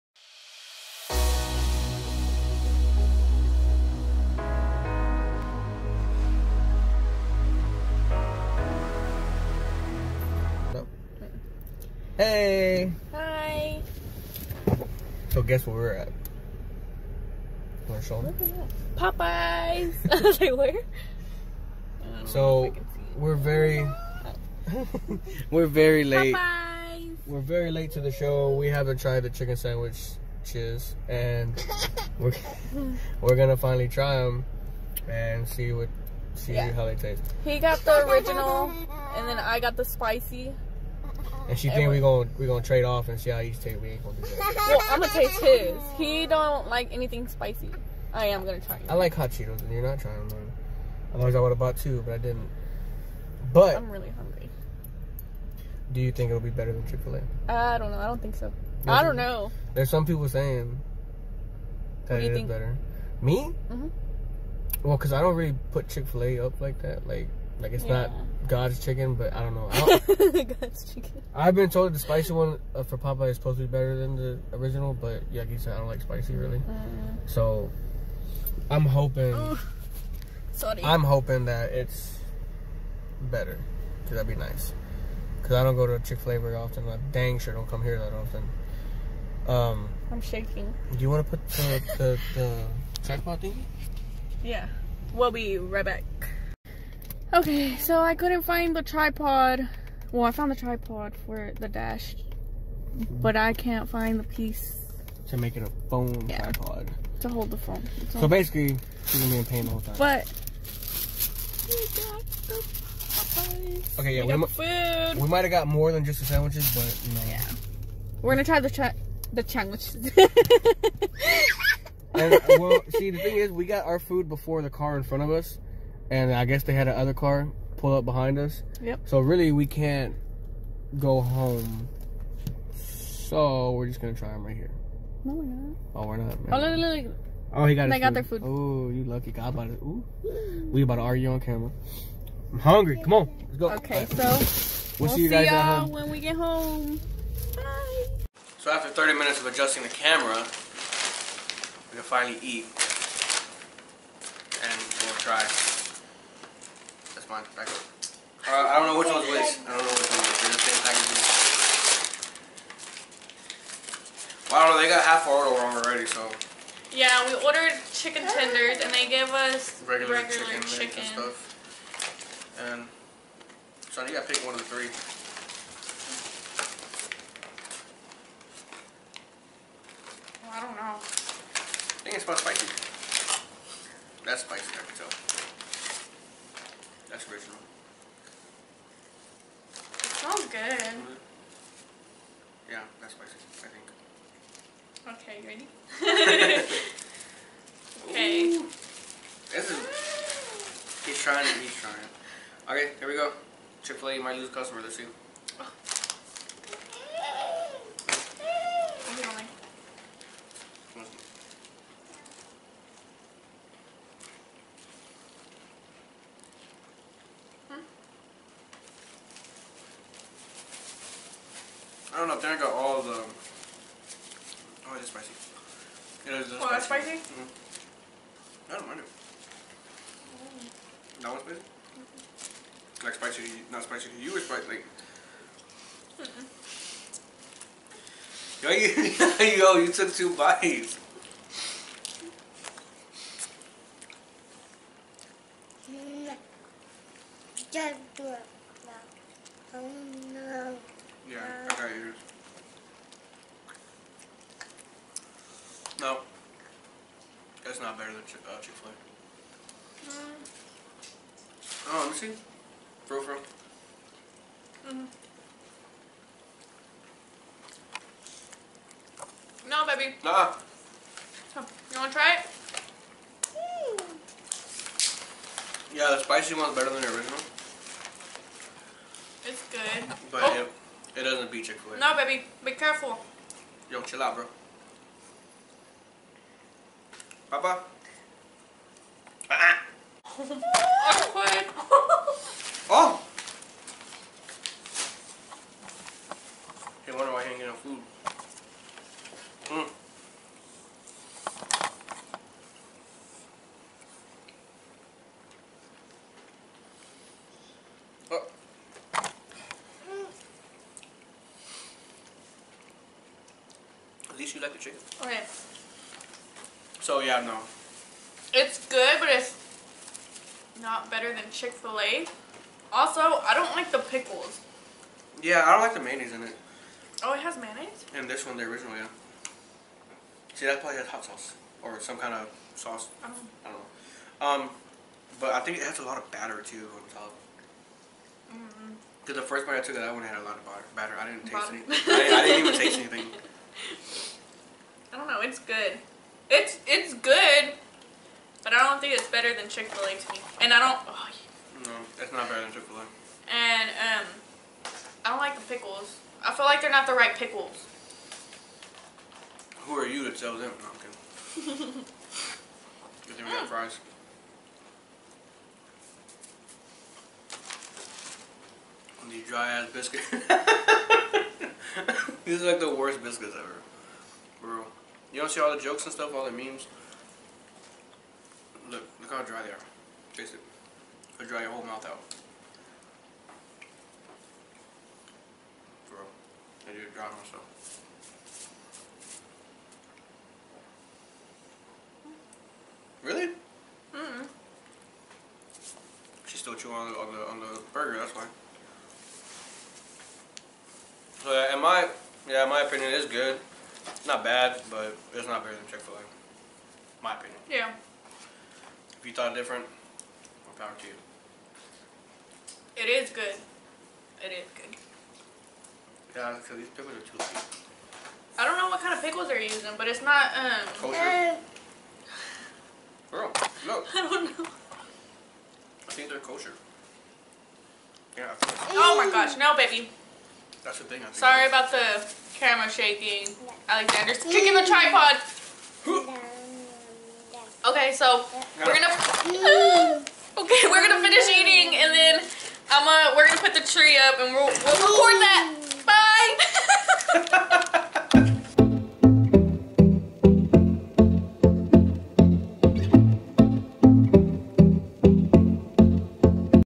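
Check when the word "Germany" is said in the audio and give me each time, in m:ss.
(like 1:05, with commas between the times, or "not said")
not said.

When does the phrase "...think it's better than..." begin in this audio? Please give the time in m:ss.
5:48.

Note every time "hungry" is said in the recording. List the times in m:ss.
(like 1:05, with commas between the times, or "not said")
0:54, 2:22.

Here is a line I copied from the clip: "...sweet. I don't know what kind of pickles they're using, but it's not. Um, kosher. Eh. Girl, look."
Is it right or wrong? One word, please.
right.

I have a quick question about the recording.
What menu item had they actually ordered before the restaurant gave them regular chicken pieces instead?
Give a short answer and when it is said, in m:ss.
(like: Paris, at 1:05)
chicken tenders, at 2:47.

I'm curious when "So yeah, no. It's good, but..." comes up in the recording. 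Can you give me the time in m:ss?
5:16.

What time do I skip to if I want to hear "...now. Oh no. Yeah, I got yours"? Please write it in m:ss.
4:08.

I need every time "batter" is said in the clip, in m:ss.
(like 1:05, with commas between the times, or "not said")
5:36, 5:40.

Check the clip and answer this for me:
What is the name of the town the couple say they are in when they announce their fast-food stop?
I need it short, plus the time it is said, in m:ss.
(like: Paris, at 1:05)
Marshall, at 0:17.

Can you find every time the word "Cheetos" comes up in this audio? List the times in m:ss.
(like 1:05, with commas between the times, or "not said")
0:49.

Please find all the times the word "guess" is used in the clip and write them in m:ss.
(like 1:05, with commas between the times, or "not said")
0:15, 2:06.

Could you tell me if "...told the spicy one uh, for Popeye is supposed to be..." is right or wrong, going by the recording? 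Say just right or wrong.
right.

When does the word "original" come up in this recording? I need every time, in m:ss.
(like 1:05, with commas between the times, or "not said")
0:38, 1:14, 3:07, 4:37, 5:28.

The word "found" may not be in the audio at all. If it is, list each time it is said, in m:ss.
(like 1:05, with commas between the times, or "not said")
1:40.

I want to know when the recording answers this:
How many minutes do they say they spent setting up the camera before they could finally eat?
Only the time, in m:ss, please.
2:28.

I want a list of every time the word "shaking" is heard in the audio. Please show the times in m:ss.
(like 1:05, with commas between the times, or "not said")
1:30, 7:12.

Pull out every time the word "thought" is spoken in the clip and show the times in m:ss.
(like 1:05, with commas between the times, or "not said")
6:49.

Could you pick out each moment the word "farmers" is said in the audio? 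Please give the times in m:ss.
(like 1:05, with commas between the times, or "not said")
not said.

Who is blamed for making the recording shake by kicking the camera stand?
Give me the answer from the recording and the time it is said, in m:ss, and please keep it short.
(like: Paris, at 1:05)
Alexander, at 7:13.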